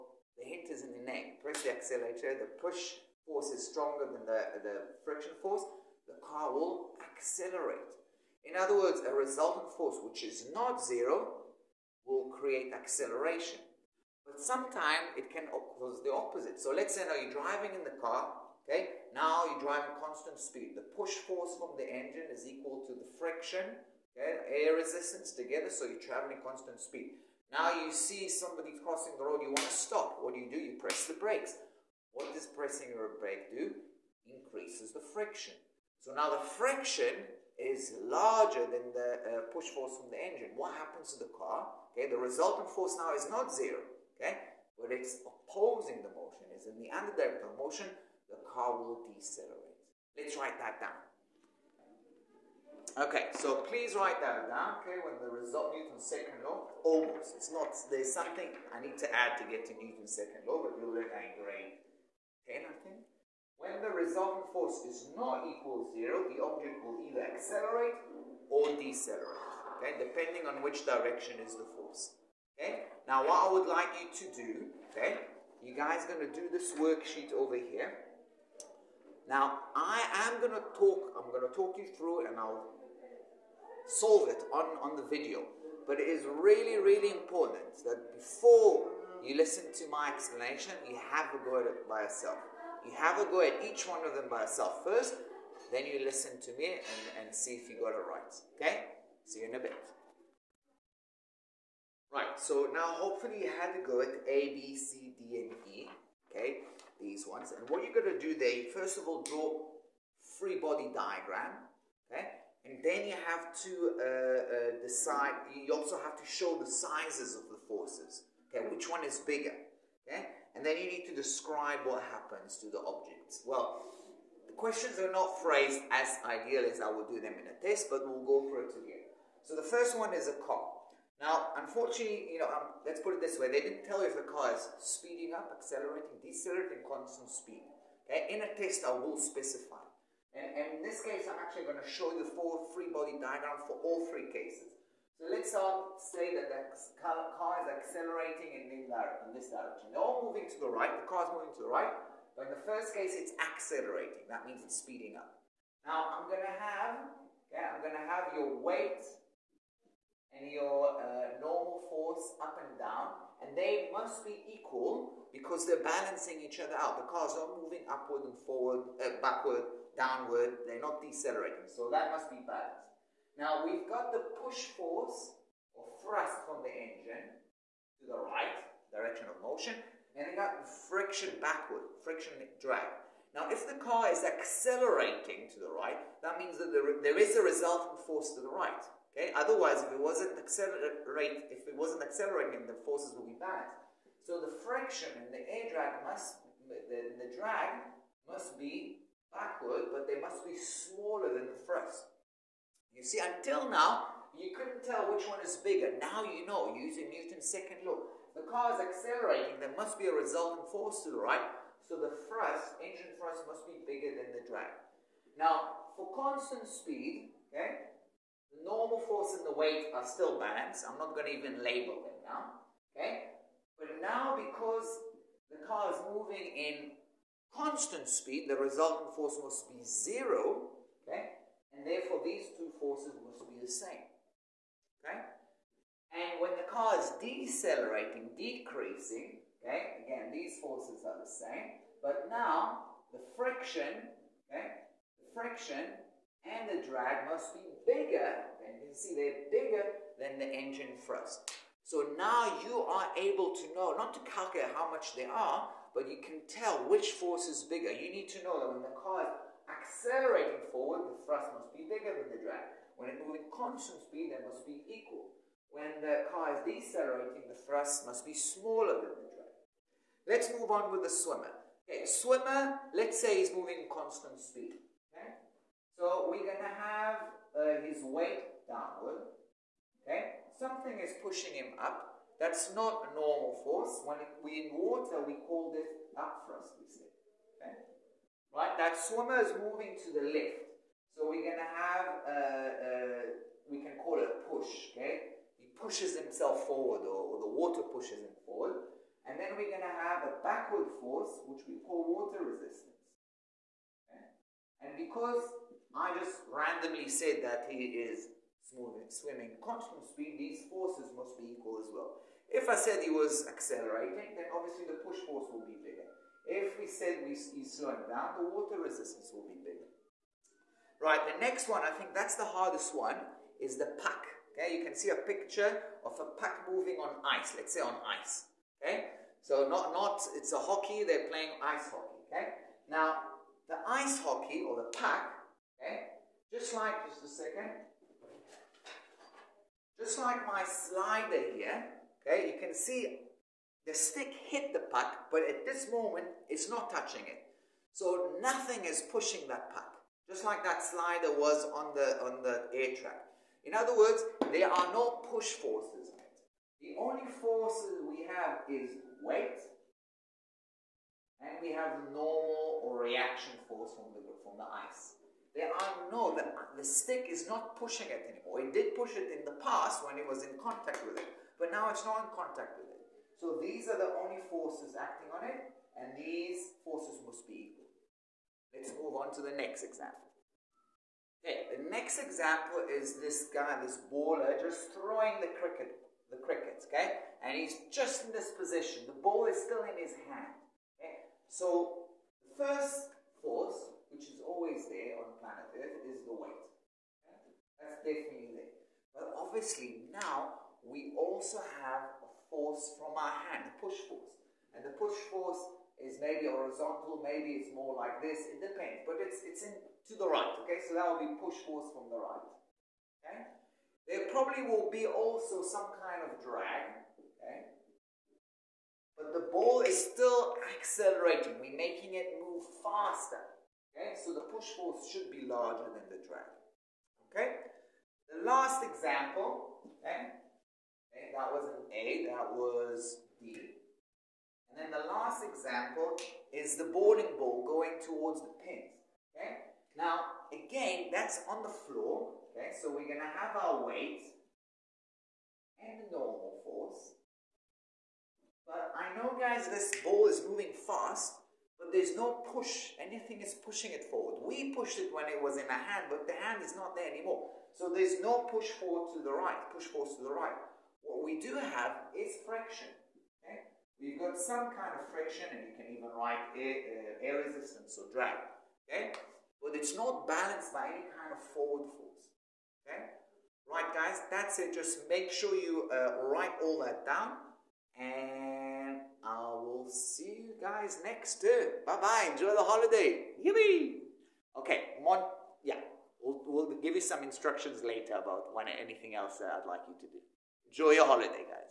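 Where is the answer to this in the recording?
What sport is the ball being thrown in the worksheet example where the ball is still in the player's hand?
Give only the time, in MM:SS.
06:25.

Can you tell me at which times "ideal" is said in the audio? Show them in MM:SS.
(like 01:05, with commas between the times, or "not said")
02:06.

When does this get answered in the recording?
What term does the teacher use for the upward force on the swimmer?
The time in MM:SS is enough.
04:46.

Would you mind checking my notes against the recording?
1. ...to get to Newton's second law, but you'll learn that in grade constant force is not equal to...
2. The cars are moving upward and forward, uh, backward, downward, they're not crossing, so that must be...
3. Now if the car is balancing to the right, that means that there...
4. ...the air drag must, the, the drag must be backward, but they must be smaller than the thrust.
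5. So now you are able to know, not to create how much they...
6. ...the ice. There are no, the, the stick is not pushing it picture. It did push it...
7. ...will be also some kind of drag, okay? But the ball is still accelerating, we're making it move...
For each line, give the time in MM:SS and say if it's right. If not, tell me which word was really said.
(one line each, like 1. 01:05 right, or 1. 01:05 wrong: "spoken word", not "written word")
1. 00:59 wrong: "resultant", not "constant"
2. 02:47 wrong: "decelerating", not "crossing"
3. 03:03 wrong: "accelerating", not "balancing"
4. 03:15 right
5. 04:11 wrong: "calculate", not "create"
6. 06:04 wrong: "anymore", not "picture"
7. 06:54 right.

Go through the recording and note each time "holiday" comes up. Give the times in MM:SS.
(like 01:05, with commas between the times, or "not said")
08:02, 08:11.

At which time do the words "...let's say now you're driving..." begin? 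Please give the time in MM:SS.
00:16.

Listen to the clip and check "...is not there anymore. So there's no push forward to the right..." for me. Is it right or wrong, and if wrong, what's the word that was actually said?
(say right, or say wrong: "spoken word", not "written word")
right.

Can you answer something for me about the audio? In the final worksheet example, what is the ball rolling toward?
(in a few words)
The pins.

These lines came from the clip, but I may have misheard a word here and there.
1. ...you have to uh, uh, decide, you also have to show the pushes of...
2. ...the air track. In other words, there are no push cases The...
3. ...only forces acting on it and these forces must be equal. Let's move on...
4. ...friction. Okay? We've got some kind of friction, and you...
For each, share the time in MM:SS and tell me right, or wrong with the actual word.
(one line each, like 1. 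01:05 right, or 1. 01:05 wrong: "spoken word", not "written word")
1. 01:53 wrong: "sizes", not "pushes"
2. 05:52 wrong: "forces", not "cases"
3. 06:14 right
4. 07:42 right.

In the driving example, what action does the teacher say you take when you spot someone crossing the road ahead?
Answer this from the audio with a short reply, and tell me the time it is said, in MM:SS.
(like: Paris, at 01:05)
Press the brakes, at 00:30.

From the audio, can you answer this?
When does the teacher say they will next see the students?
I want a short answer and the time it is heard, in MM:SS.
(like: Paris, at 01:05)
Next term, at 08:01.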